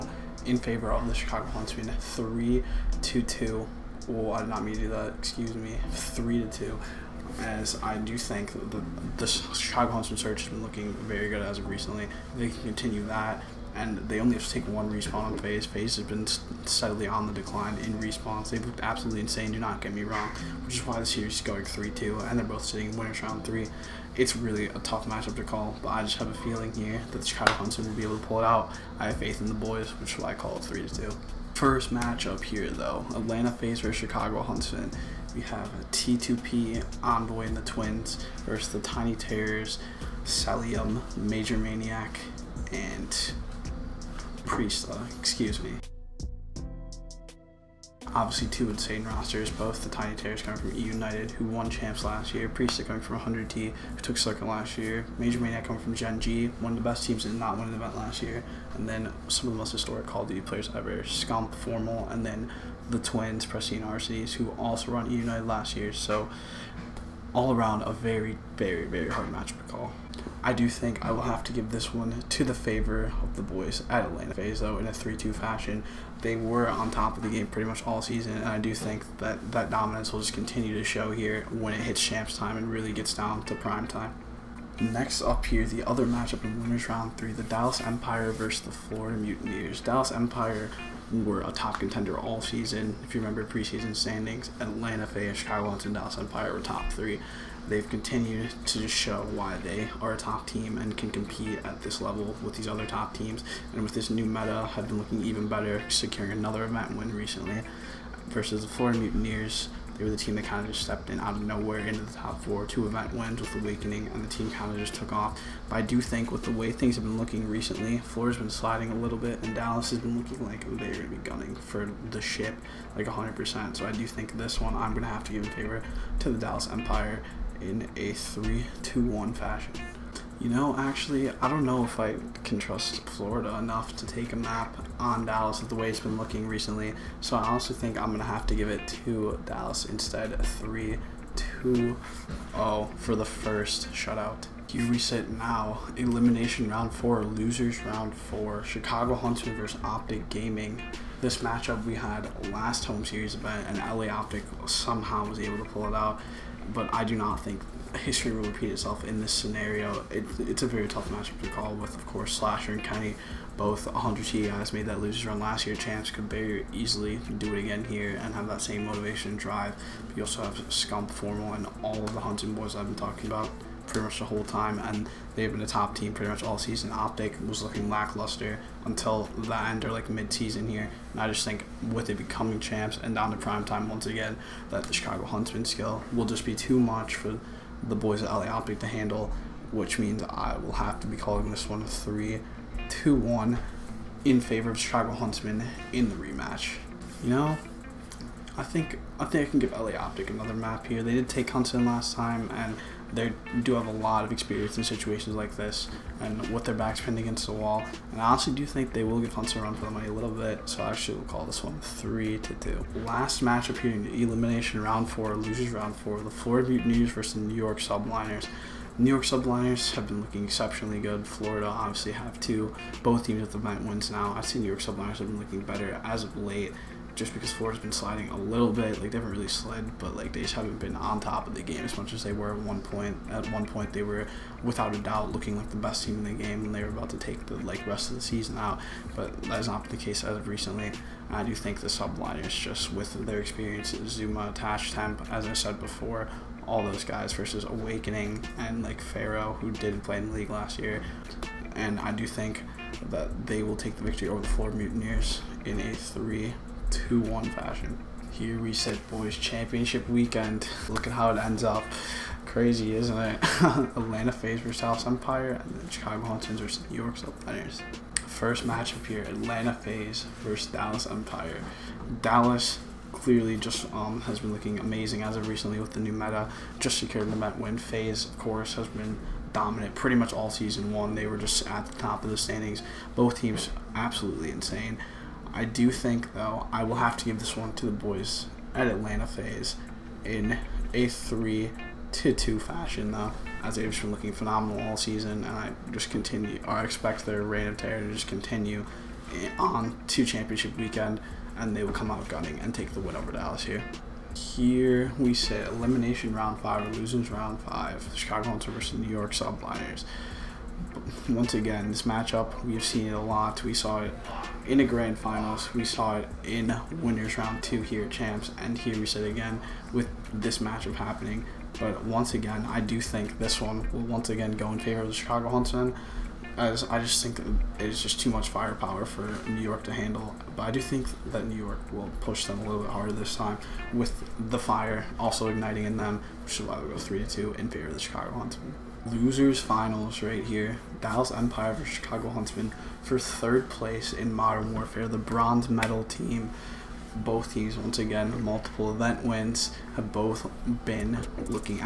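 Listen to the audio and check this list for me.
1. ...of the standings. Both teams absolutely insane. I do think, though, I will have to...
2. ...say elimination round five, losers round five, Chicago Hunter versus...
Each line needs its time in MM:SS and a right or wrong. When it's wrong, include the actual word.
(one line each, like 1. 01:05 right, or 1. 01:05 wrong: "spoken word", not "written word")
1. 04:42 right
2. 05:05 right.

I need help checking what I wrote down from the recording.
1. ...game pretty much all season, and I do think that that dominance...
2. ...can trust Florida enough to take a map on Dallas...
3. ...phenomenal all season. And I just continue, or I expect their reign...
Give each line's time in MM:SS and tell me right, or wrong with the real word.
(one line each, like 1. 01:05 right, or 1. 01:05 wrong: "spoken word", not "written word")
1. 01:17 right
2. 02:12 right
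3. 04:54 right.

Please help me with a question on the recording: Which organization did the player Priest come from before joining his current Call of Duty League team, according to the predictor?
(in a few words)
100T.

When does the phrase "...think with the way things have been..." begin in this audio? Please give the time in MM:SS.
01:55.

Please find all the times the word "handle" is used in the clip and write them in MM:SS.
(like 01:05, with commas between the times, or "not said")
03:08, 05:29.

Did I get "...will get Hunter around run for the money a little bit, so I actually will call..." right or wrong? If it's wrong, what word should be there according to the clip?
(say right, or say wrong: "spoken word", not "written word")
right.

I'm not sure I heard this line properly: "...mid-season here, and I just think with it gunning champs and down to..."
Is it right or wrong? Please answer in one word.
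wrong.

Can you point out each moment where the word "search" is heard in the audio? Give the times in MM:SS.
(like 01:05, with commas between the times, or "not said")
00:10.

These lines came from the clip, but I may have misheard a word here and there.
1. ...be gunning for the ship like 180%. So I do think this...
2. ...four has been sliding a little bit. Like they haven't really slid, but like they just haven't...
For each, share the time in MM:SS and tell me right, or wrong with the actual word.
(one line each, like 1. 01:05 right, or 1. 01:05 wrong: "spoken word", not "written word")
1. 02:01 wrong: "100", not "180"
2. 03:47 right.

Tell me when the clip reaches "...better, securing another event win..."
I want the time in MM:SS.
01:45.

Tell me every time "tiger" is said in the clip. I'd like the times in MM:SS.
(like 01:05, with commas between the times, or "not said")
not said.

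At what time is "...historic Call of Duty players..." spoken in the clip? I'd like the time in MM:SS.
00:59.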